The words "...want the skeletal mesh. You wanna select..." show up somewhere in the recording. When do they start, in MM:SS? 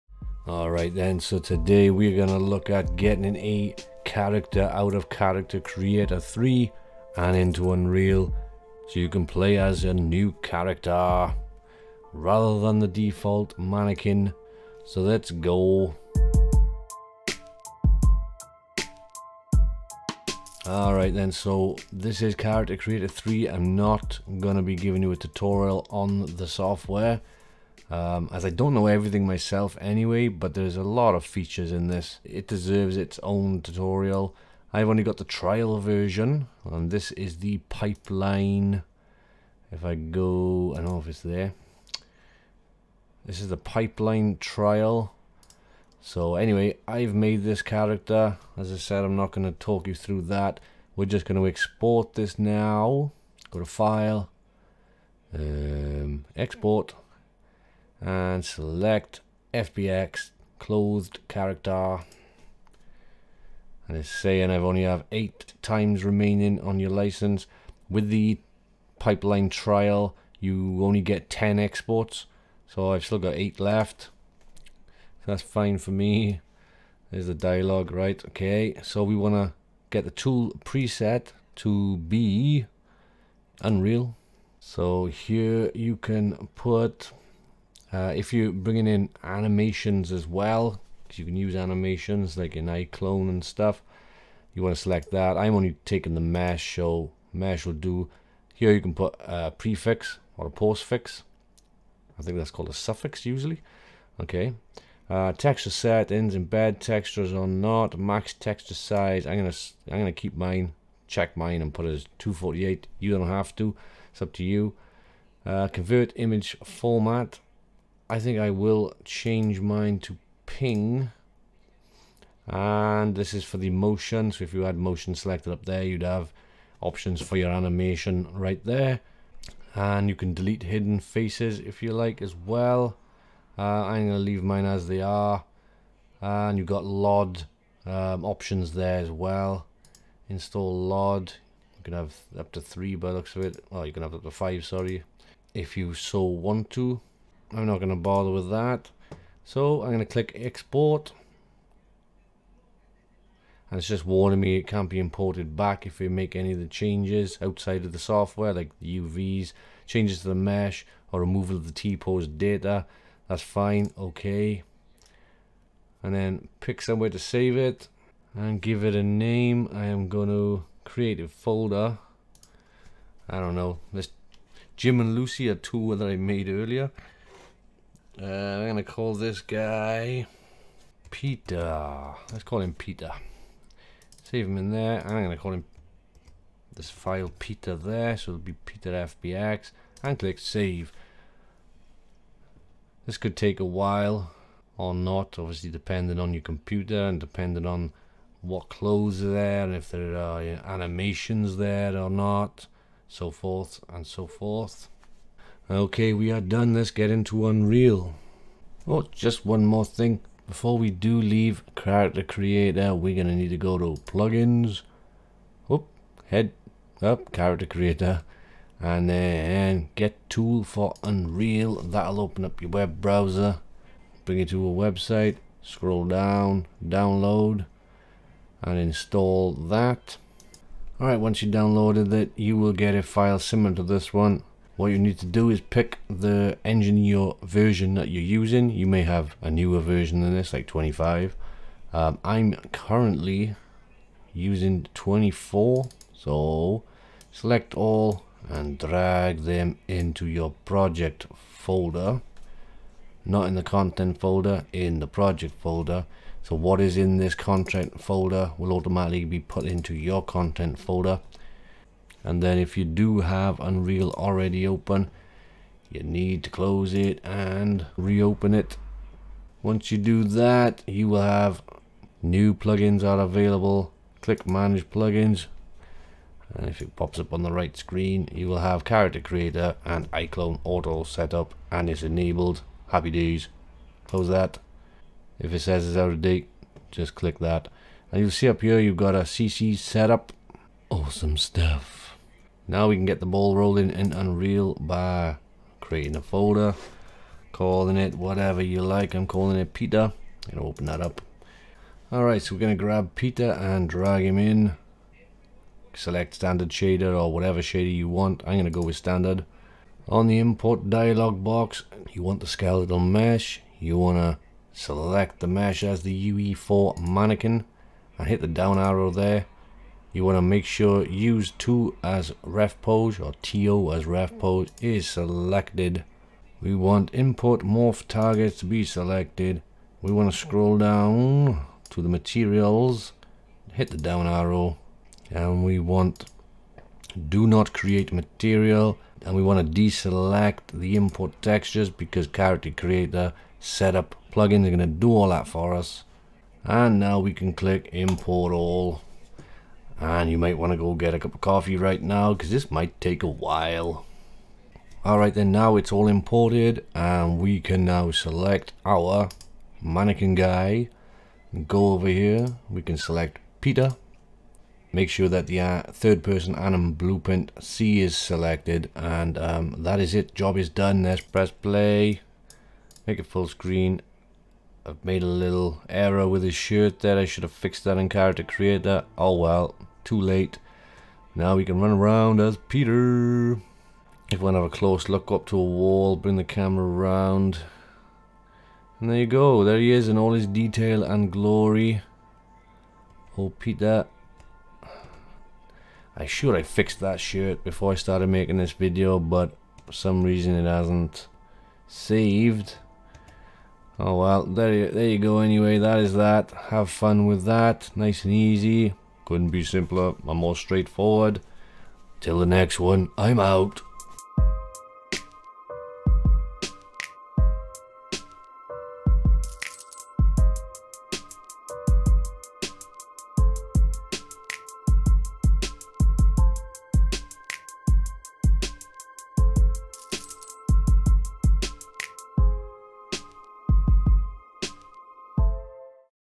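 05:12.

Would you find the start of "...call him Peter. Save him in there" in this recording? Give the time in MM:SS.
03:02.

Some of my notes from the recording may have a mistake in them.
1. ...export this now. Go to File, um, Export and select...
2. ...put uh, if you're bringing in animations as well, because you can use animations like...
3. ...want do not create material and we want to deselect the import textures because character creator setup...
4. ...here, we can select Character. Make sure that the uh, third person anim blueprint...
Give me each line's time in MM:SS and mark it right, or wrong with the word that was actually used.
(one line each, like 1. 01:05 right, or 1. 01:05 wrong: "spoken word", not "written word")
1. 00:51 right
2. 01:26 right
3. 05:35 right
4. 06:02 wrong: "Peter", not "Character".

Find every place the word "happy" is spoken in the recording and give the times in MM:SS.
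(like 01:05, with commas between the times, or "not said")
04:42.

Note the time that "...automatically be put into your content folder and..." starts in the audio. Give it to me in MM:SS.
04:18.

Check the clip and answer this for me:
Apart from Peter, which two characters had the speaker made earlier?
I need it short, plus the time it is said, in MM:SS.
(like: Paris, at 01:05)
Jim and Lucy, at 02:54.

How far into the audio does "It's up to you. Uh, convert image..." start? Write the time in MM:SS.
01:54.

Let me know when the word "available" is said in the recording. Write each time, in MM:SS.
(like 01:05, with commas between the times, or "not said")
04:33.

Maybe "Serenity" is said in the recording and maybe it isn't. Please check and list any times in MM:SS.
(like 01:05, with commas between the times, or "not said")
not said.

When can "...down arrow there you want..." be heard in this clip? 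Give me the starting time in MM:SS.
05:18.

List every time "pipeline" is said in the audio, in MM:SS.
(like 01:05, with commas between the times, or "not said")
00:37, 00:43, 01:08.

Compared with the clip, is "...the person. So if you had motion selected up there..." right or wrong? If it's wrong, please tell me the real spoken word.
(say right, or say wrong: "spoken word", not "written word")
wrong: "motion", not "person".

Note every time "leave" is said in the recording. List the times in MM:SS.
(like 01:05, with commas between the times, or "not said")
02:14, 03:31.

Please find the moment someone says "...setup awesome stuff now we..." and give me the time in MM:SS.
04:49.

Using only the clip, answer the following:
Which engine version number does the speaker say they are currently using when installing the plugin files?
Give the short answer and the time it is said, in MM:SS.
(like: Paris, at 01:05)
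24, at 04:04.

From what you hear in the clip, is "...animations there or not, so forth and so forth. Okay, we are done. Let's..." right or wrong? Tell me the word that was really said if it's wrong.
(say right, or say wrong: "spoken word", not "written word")
right.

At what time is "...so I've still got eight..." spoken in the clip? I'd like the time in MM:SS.
01:12.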